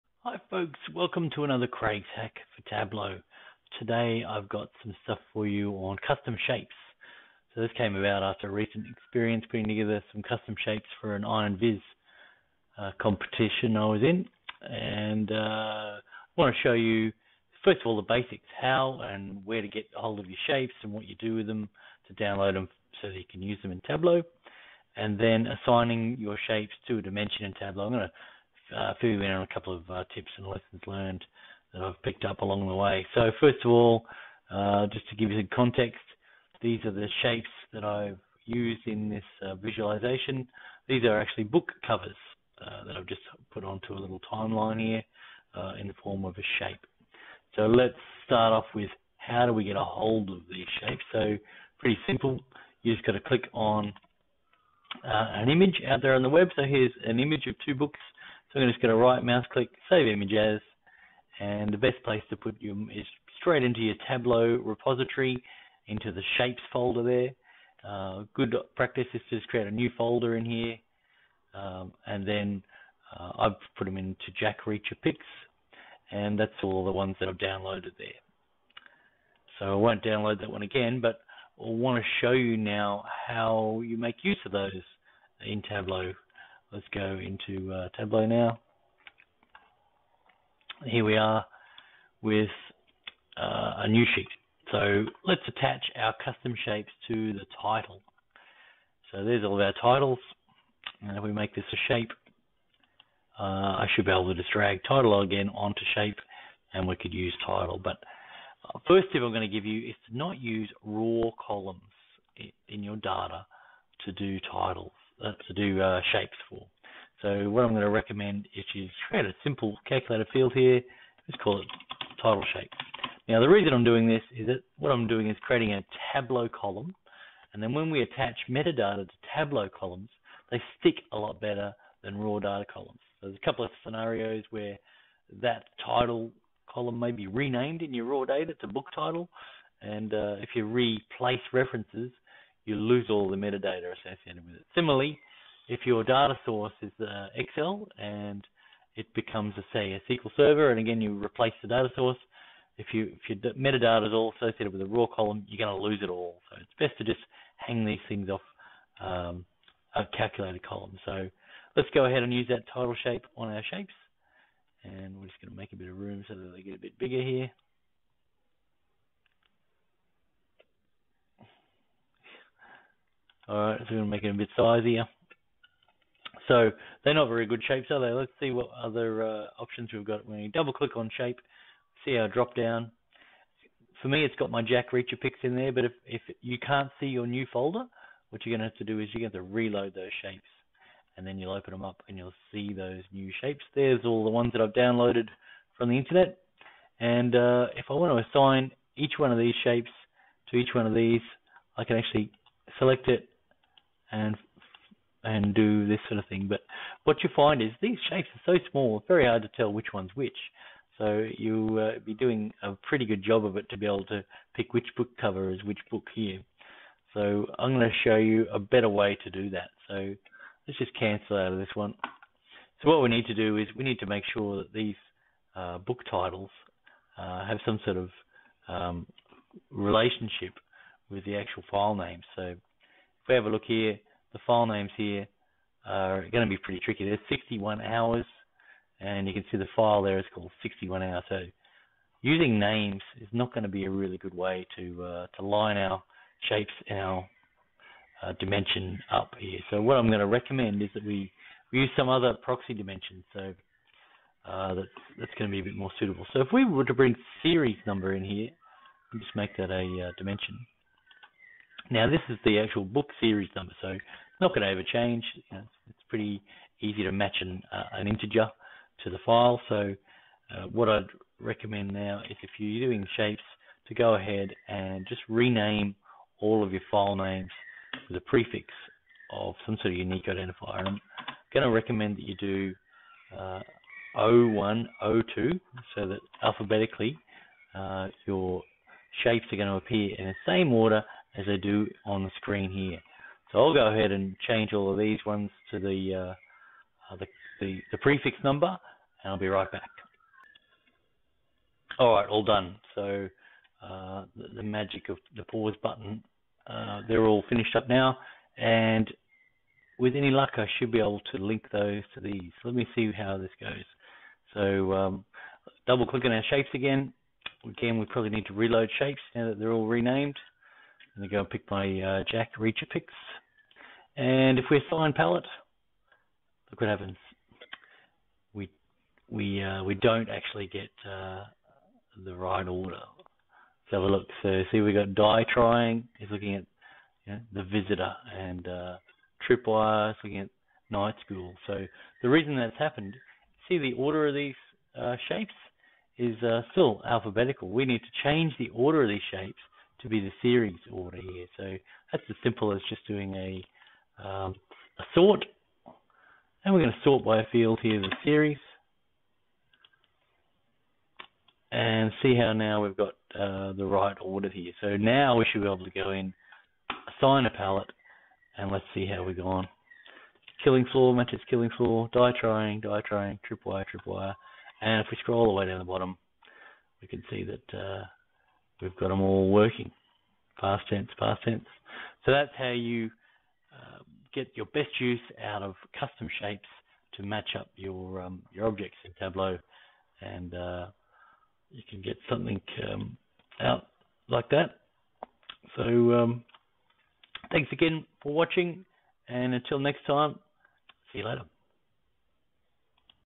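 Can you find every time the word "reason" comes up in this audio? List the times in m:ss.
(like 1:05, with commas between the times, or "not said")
2:03, 5:42.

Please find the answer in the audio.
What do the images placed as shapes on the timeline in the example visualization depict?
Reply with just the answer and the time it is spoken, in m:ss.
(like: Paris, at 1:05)
Book covers, at 0:41.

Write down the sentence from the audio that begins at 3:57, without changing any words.
There's 61 hours, and you can see the file there is called 61 hours.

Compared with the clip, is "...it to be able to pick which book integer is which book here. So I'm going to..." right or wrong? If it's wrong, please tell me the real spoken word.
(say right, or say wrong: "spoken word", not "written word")
wrong: "cover", not "integer".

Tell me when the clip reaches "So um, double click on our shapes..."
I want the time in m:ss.
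5:14.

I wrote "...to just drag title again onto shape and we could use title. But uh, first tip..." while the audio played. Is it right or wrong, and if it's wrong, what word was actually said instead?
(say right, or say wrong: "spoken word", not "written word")
right.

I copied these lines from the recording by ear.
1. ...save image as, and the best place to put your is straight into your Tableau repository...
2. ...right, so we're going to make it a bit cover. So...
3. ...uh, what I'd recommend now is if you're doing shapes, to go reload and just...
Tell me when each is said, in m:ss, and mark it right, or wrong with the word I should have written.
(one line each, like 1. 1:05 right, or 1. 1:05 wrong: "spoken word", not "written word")
1. 0:59 right
2. 2:53 wrong: "sizier", not "cover"
3. 4:30 wrong: "ahead", not "reload".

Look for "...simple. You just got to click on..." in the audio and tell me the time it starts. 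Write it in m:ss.
0:52.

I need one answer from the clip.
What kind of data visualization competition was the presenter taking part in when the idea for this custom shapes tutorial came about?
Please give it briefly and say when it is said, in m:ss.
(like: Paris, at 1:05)
Iron Viz, at 0:11.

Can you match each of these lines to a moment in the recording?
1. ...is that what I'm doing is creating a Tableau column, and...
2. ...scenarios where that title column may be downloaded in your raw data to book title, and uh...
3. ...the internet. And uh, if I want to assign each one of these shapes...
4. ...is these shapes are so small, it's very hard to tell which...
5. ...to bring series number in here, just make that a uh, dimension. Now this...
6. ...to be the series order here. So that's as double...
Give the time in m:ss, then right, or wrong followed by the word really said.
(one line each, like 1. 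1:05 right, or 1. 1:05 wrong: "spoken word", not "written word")
1. 2:04 right
2. 2:13 wrong: "renamed", not "downloaded"
3. 3:15 right
4. 3:27 right
5. 4:16 right
6. 5:50 wrong: "simple", not "double".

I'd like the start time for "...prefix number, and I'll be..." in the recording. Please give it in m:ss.
4:57.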